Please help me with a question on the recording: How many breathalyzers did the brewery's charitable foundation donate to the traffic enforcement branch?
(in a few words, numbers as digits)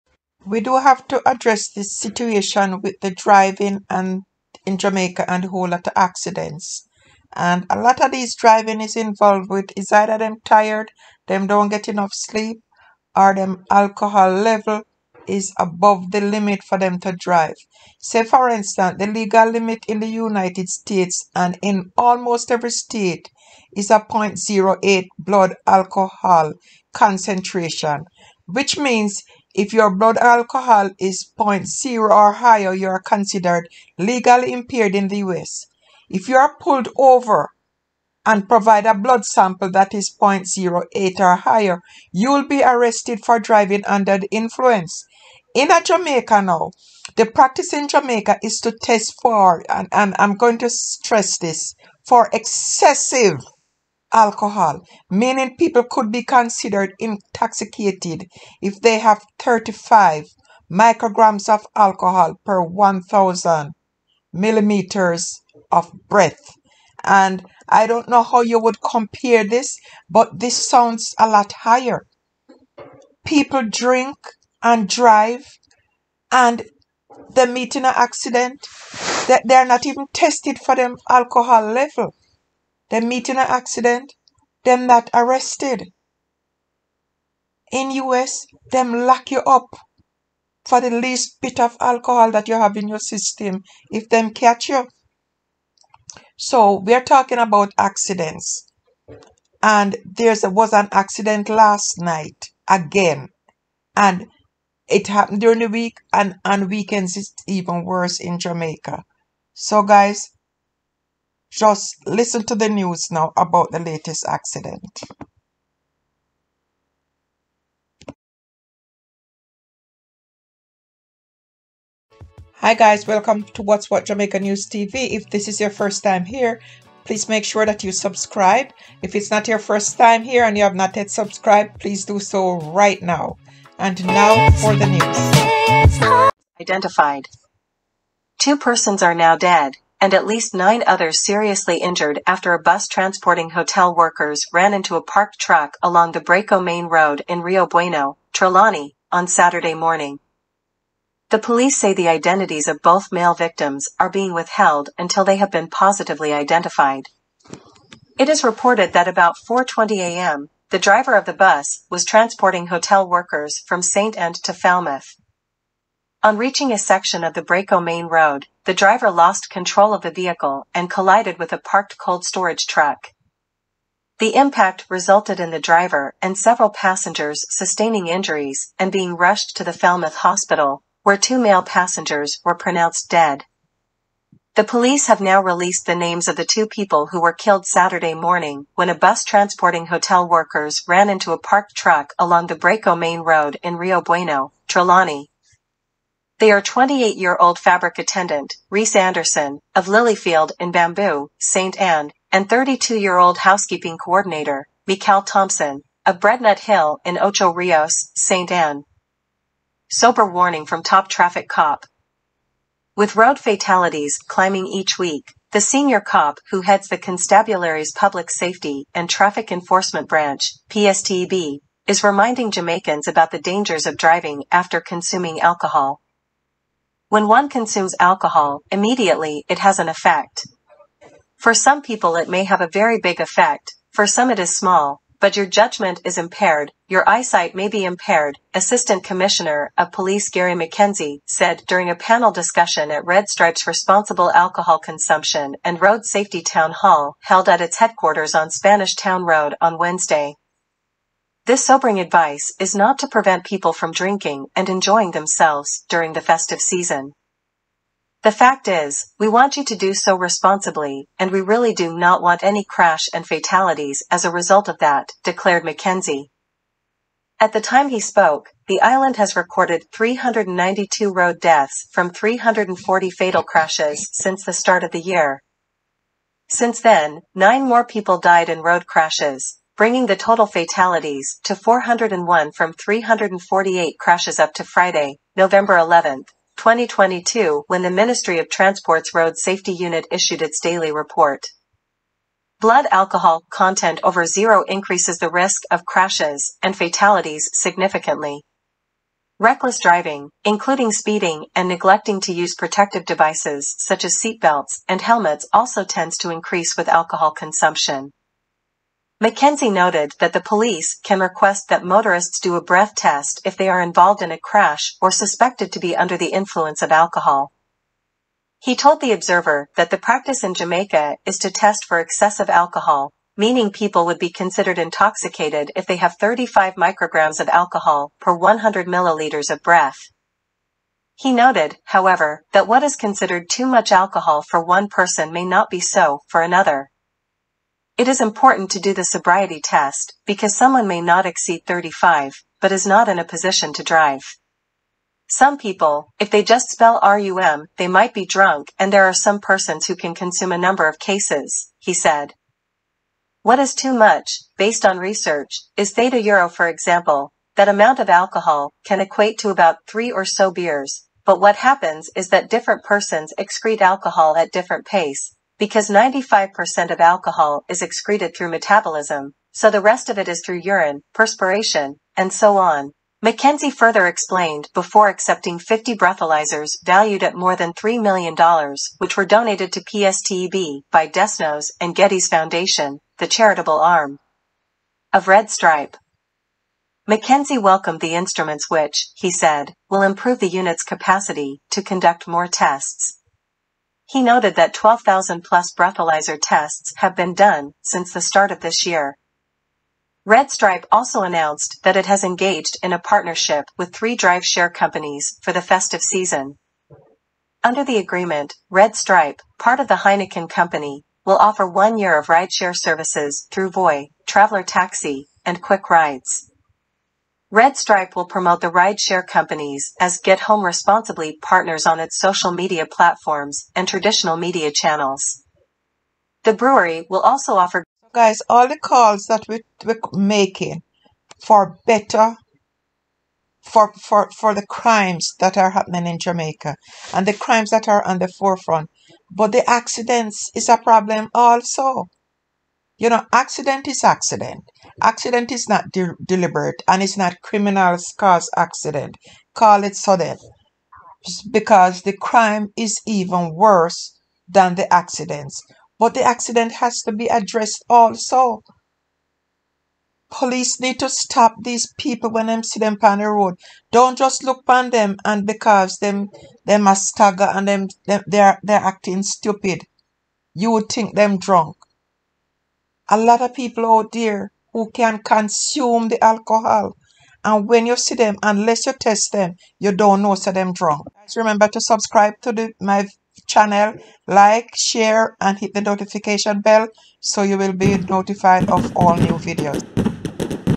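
50.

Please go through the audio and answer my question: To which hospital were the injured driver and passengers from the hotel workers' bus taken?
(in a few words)
Falmouth Hospital.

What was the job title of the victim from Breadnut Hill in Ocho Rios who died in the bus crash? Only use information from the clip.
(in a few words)
housekeeping coordinator.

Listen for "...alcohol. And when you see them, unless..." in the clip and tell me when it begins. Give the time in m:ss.
7:56.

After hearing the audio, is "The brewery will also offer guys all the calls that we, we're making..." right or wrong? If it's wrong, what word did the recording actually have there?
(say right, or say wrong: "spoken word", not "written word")
right.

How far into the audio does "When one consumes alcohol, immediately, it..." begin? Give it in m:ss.
3:47.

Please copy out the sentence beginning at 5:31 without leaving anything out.
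He noted, however, that what is considered too much alcohol for one person may not be so for another.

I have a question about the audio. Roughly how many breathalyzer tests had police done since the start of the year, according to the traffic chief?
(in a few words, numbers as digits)
12,000.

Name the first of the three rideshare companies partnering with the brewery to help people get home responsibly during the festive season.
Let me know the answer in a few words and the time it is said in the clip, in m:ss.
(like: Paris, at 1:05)
Voy, at 6:53.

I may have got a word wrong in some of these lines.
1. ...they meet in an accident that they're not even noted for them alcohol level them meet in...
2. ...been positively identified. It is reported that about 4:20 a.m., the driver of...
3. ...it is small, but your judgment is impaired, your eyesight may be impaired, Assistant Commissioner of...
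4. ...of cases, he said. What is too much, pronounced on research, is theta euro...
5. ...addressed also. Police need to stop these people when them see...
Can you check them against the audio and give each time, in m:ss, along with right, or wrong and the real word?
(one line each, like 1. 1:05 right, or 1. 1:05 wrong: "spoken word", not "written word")
1. 1:17 wrong: "tested", not "noted"
2. 2:35 right
3. 3:54 right
4. 5:50 wrong: "based", not "pronounced"
5. 7:37 right.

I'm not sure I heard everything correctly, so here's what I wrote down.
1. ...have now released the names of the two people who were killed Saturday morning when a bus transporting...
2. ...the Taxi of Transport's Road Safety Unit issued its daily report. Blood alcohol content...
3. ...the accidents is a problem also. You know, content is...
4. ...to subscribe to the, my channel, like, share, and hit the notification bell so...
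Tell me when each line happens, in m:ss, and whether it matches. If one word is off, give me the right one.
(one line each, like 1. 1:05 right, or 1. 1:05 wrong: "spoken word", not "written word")
1. 3:05 right
2. 4:47 wrong: "Ministry", not "Taxi"
3. 7:19 wrong: "accident", not "content"
4. 8:01 right.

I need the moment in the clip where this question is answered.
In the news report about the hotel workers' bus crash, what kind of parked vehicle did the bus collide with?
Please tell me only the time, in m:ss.
2:51.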